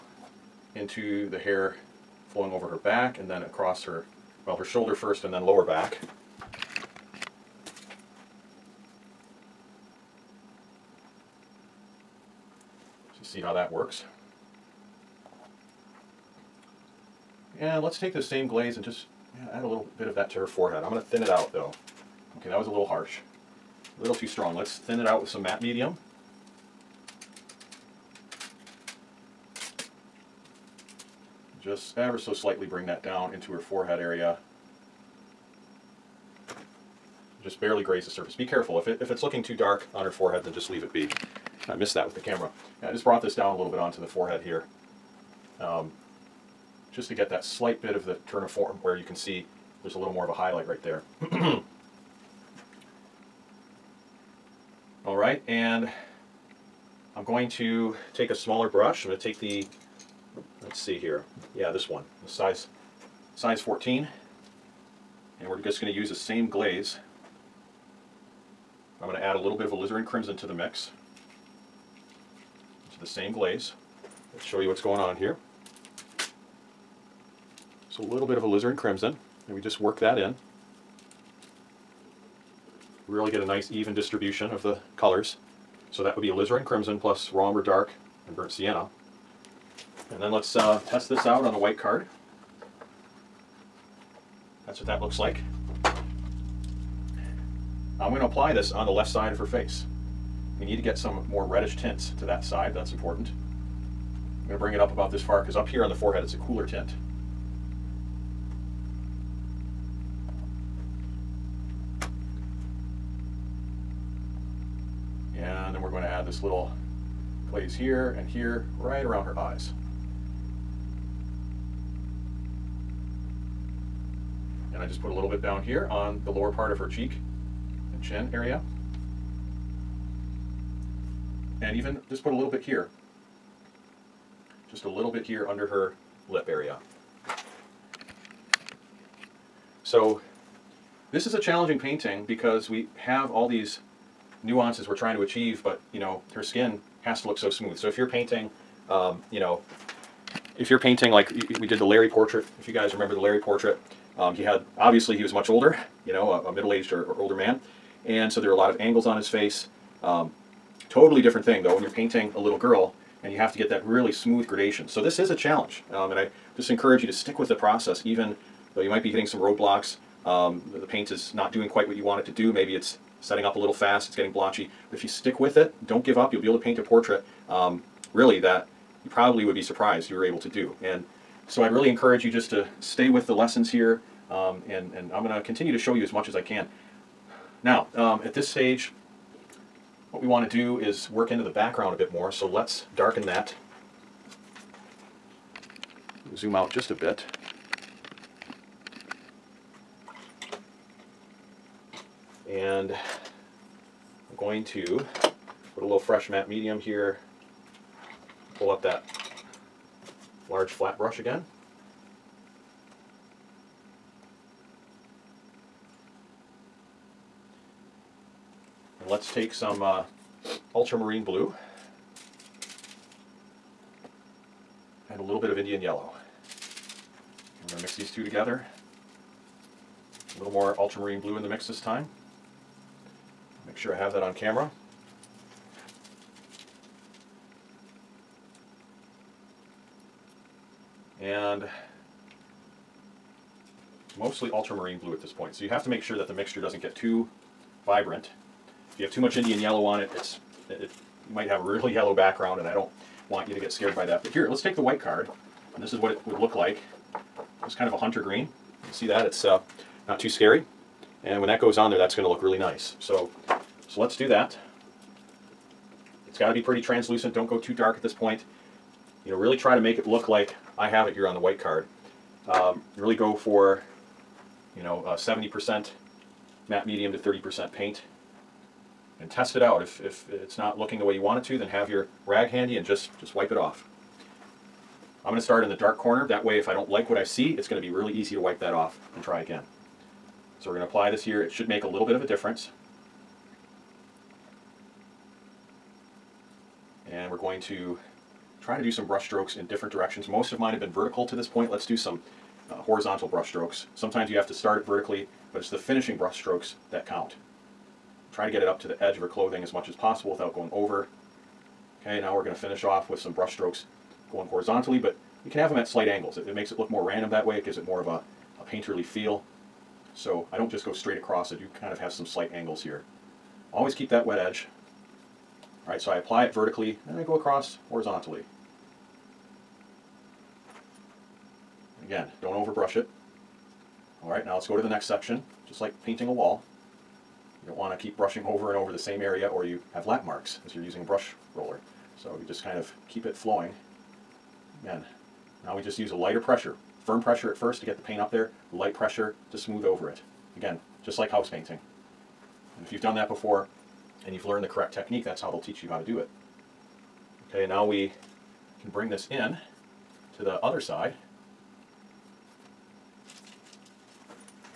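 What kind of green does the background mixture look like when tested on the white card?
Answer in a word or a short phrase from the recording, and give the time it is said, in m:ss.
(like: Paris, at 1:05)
hunter green, at 4:17.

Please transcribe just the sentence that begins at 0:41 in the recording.
I missed that with the camera.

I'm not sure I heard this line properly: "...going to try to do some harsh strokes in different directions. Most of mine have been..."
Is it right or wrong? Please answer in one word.
wrong.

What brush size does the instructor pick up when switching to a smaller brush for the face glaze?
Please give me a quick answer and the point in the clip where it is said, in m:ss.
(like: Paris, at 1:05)
14, at 1:03.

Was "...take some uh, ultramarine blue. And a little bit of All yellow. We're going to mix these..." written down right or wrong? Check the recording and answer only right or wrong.
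wrong.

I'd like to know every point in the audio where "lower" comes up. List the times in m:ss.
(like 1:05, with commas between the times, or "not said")
0:05, 2:06.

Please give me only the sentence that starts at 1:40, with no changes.
We need to get some more reddish tints to that side, that's important.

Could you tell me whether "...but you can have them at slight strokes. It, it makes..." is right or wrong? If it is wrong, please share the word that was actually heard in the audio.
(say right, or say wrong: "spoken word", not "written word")
wrong: "angles", not "strokes".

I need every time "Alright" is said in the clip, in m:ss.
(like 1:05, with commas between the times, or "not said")
5:25, 5:34.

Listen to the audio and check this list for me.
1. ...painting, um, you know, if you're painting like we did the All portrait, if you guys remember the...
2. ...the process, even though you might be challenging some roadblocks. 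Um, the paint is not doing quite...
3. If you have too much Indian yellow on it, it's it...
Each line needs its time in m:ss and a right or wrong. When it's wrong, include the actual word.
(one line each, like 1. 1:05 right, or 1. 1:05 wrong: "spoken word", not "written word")
1. 2:28 wrong: "Larry", not "All"
2. 2:47 wrong: "hitting", not "challenging"
3. 4:08 right.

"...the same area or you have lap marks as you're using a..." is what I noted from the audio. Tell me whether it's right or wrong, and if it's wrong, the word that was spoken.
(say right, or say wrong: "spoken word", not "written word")
right.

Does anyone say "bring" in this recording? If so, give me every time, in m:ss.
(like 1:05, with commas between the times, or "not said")
0:32, 1:44, 5:58.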